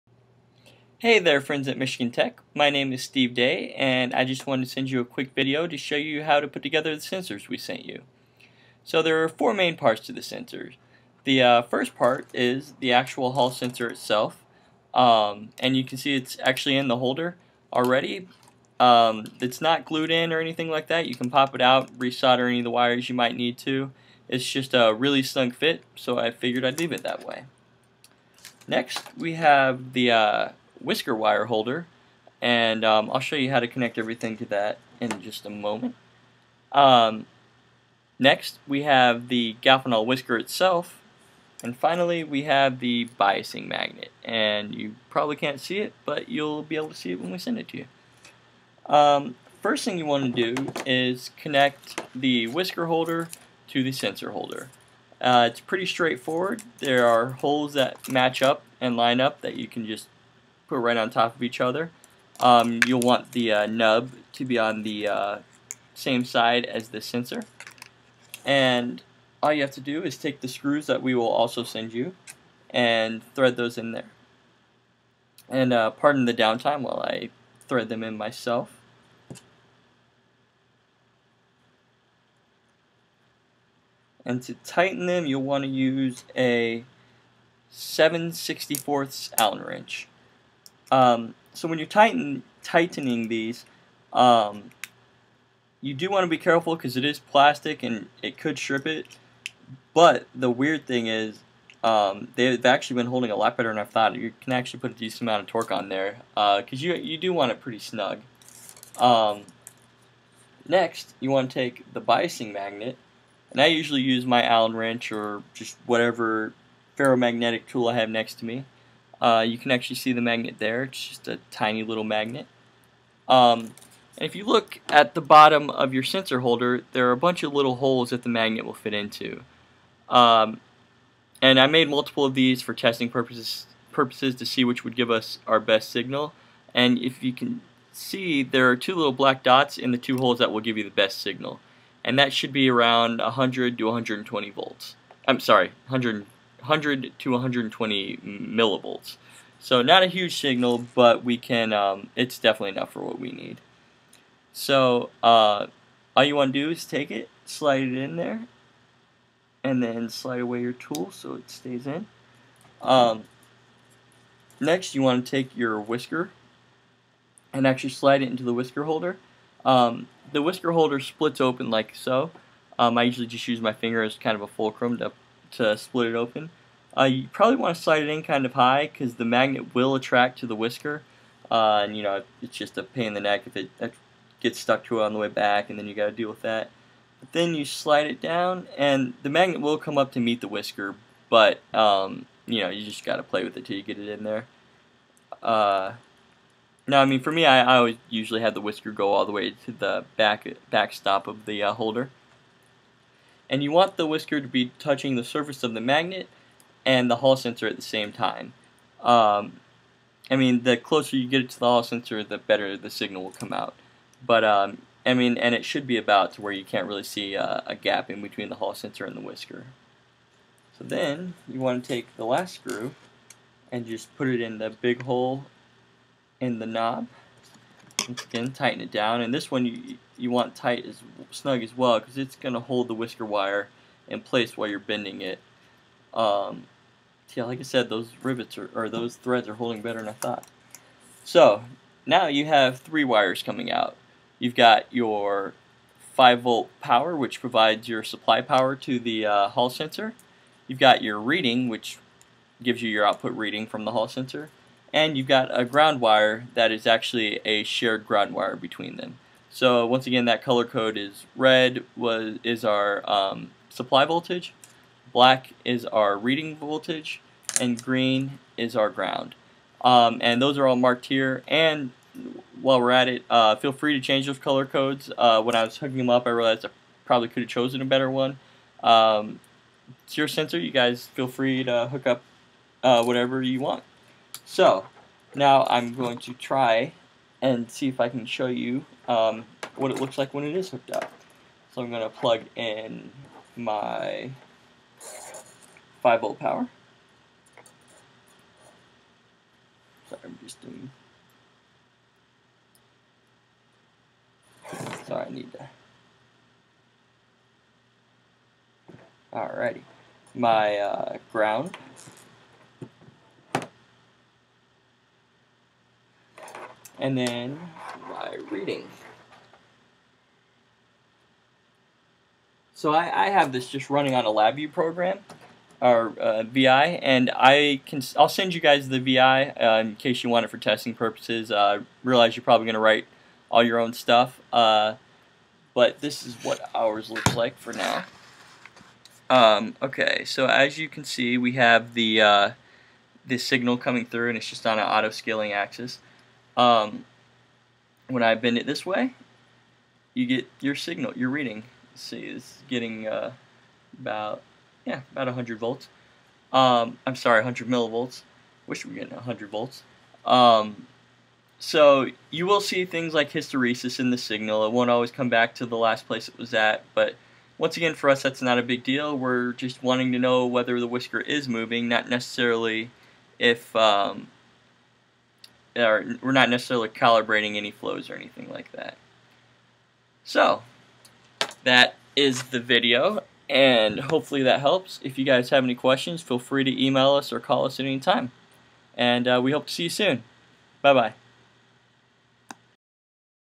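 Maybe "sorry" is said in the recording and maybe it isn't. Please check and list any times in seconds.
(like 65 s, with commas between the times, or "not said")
145 s, 300 s, 305 s, 357 s.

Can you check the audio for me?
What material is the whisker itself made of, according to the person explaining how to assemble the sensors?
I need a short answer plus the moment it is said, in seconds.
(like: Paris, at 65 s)
Galfenol, at 39 s.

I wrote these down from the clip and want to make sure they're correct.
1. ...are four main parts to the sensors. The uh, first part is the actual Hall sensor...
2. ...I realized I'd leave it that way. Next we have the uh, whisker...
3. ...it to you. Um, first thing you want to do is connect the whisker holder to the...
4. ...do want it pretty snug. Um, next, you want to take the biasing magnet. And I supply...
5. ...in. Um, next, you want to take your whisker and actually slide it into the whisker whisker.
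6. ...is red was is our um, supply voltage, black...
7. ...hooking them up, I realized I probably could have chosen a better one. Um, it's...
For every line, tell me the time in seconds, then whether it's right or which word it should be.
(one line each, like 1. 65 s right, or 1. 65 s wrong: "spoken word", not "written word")
1. 9 s right
2. 26 s wrong: "figured", not "realized"
3. 47 s right
4. 107 s wrong: "usually", not "supply"
5. 161 s wrong: "holder", not "whisker"
6. 260 s right
7. 275 s right.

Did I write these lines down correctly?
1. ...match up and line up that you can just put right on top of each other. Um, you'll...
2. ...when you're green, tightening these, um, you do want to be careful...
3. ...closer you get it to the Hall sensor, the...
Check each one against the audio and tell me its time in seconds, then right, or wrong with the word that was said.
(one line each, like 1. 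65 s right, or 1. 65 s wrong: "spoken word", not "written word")
1. 58 s right
2. 91 s wrong: "tighten", not "green"
3. 210 s right.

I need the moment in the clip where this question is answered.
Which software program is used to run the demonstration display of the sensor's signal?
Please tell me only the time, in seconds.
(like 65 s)
324 s.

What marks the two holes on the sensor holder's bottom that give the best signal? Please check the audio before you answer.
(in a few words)
Two little black dots.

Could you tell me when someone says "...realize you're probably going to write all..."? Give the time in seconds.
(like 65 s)
332 s.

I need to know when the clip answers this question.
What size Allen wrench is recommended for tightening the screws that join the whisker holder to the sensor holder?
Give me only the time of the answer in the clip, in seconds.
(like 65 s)
87 s.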